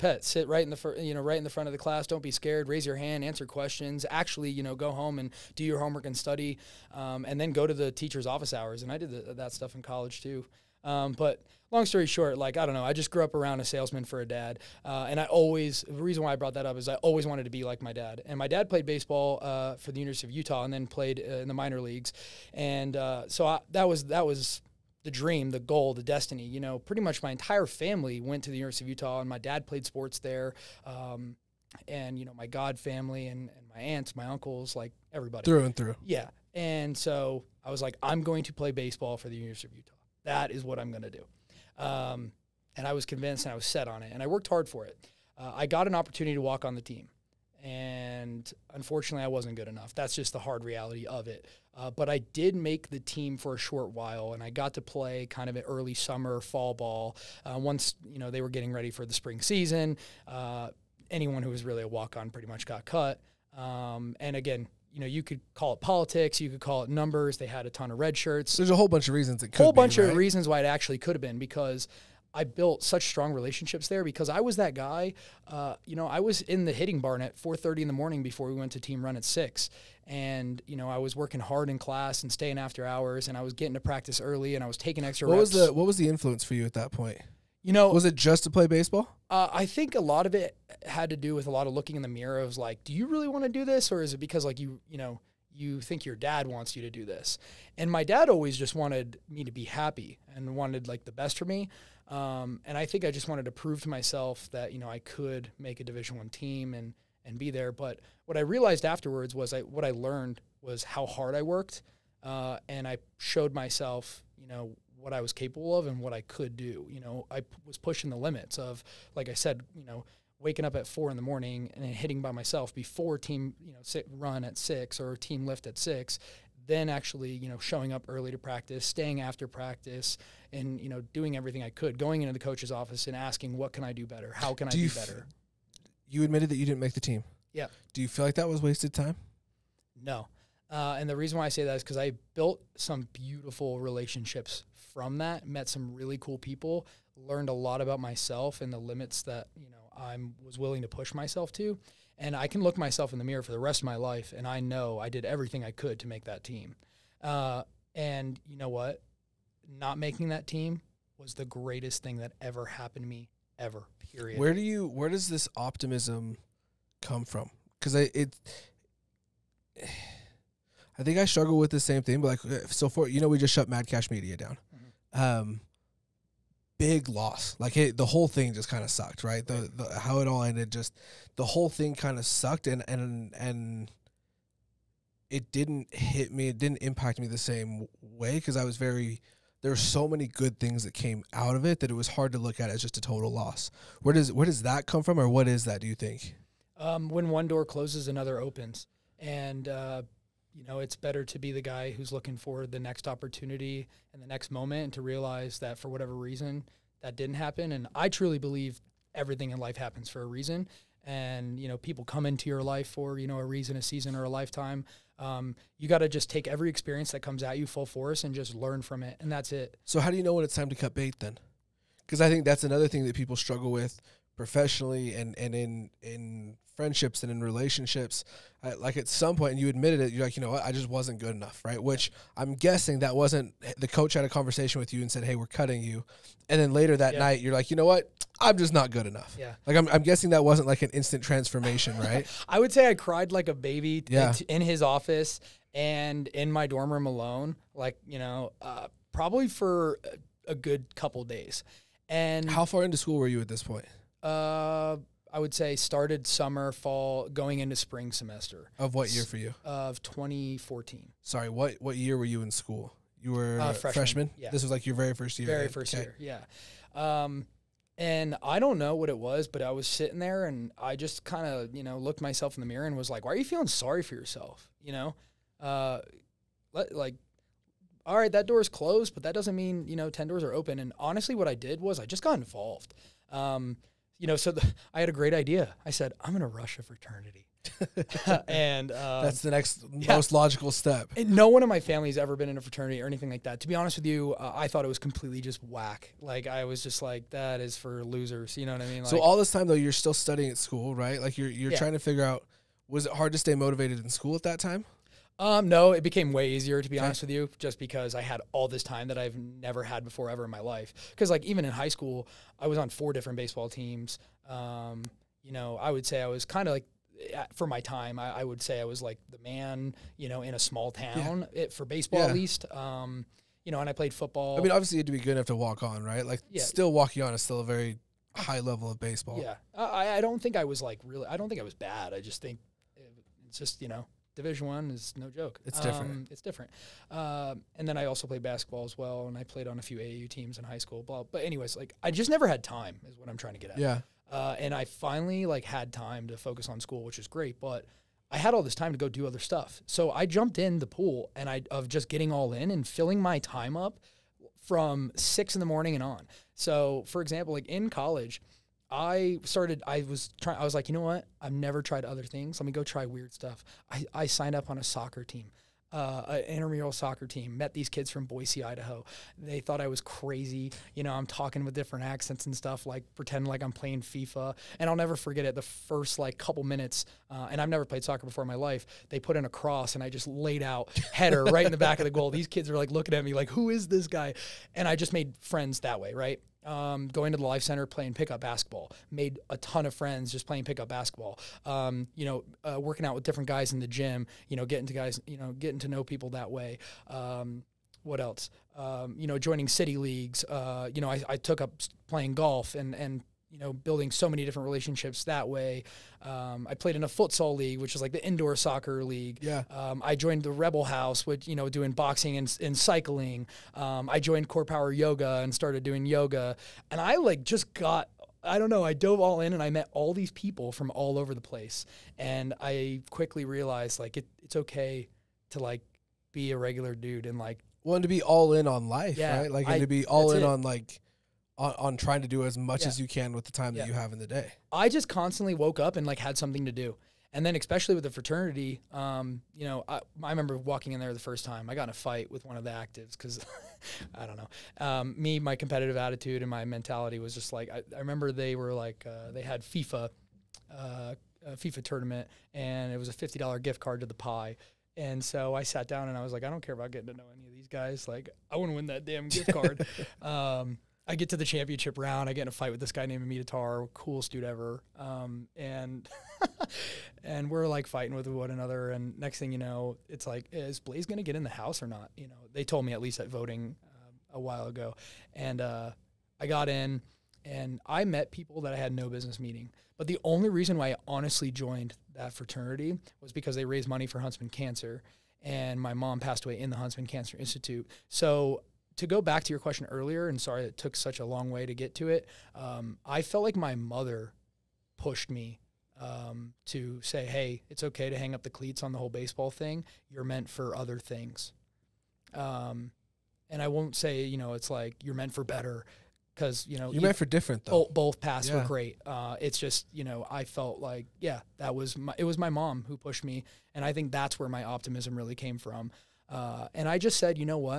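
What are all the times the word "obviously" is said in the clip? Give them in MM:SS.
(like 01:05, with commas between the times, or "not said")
05:24.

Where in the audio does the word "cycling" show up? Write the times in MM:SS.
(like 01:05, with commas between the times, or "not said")
06:52.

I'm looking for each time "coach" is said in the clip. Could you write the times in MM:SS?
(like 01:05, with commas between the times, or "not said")
02:12, 03:53.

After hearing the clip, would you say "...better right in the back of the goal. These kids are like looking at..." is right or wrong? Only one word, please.
wrong.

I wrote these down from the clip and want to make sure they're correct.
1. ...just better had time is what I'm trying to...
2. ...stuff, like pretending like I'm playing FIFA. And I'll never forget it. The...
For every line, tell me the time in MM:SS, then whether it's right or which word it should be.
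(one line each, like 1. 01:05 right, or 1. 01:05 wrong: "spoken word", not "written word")
1. 05:42 wrong: "never", not "better"
2. 06:12 right.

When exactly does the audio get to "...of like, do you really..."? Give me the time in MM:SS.
01:32.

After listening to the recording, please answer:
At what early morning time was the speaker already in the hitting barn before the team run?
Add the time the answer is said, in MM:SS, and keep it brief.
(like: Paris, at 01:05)
4:30, at 01:17.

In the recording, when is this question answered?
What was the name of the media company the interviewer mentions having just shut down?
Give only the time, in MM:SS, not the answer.
02:53.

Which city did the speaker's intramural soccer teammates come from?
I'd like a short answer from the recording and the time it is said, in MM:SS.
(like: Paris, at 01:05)
Boise, Idaho, at 06:08.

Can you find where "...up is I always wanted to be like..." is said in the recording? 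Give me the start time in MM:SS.
00:16.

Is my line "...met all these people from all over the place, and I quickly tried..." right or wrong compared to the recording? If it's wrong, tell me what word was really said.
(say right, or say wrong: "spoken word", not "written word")
wrong: "realized", not "tried".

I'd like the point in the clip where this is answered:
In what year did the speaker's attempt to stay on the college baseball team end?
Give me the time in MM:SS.
04:20.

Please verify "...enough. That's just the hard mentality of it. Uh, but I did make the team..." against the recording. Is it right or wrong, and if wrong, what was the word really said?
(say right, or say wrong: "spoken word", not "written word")
wrong: "reality", not "mentality".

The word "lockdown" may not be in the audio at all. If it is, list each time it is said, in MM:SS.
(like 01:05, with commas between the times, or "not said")
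not said.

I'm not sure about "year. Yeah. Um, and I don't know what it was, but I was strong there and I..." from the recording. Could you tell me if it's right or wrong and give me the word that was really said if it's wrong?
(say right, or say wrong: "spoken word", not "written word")
wrong: "sitting", not "strong".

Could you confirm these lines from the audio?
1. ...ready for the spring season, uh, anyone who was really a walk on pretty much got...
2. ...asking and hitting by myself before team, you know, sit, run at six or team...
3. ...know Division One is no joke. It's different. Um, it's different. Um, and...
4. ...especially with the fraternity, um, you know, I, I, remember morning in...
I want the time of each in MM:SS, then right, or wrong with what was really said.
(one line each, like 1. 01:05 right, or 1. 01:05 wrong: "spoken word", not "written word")
1. 00:58 right
2. 02:01 wrong: "morning", not "asking"
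3. 05:33 right
4. 07:17 wrong: "walking", not "morning".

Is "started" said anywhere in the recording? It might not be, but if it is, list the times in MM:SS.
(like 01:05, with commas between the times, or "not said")
04:15, 05:59, 06:55.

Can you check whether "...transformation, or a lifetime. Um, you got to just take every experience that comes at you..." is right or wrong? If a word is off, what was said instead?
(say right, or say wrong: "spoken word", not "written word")
wrong: "season", not "transformation".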